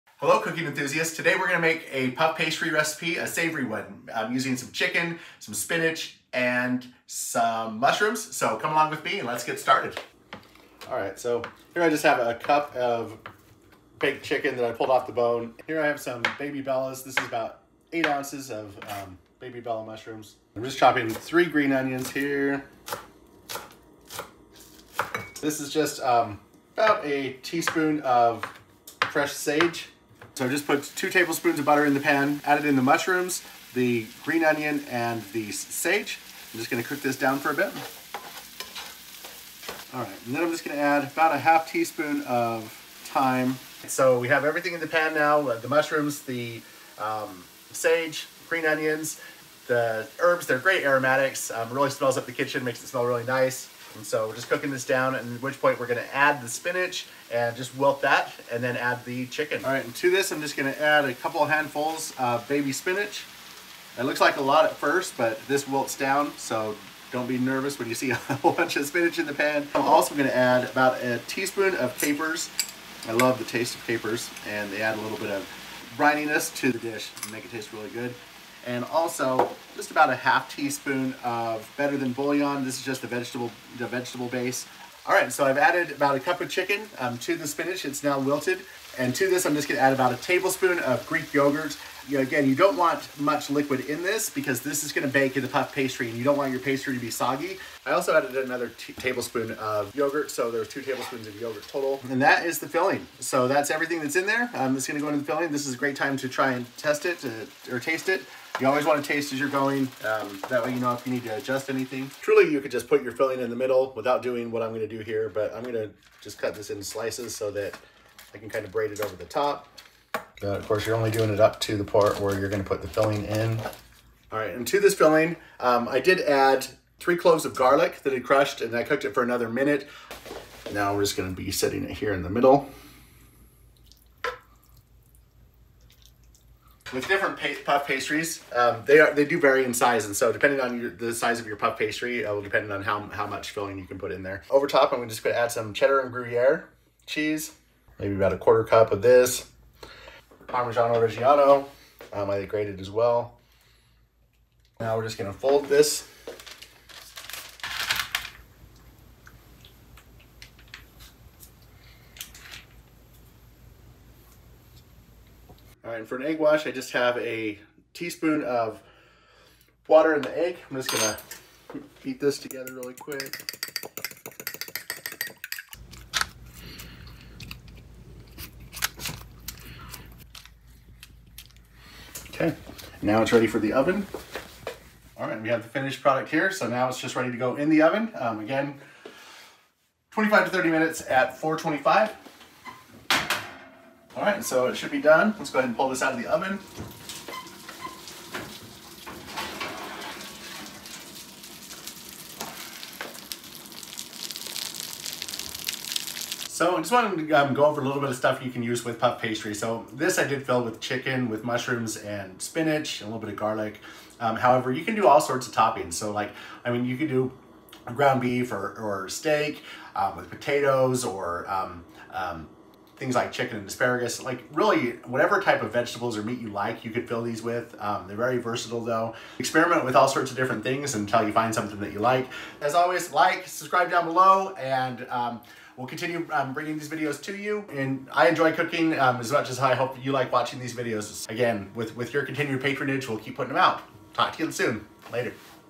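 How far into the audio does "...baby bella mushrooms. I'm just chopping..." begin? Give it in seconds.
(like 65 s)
19 s.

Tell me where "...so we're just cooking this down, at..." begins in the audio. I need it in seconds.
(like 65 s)
54 s.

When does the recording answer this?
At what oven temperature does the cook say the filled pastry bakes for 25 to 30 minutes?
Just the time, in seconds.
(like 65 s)
191 s.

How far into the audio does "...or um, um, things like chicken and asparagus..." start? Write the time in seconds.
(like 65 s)
221 s.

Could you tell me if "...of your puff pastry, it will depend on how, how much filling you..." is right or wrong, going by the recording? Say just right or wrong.
right.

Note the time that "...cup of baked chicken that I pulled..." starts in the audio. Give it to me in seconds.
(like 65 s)
12 s.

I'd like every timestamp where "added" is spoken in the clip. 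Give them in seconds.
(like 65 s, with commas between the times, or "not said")
32 s, 85 s, 98 s.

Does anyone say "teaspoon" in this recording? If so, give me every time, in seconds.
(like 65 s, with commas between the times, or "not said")
27 s, 41 s, 71 s, 80 s, 167 s.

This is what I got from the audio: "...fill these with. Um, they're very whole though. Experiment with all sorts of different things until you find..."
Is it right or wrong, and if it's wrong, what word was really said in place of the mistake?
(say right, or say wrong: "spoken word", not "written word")
wrong: "versatile", not "whole".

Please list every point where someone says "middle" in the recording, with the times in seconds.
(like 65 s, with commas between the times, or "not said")
113 s, 132 s.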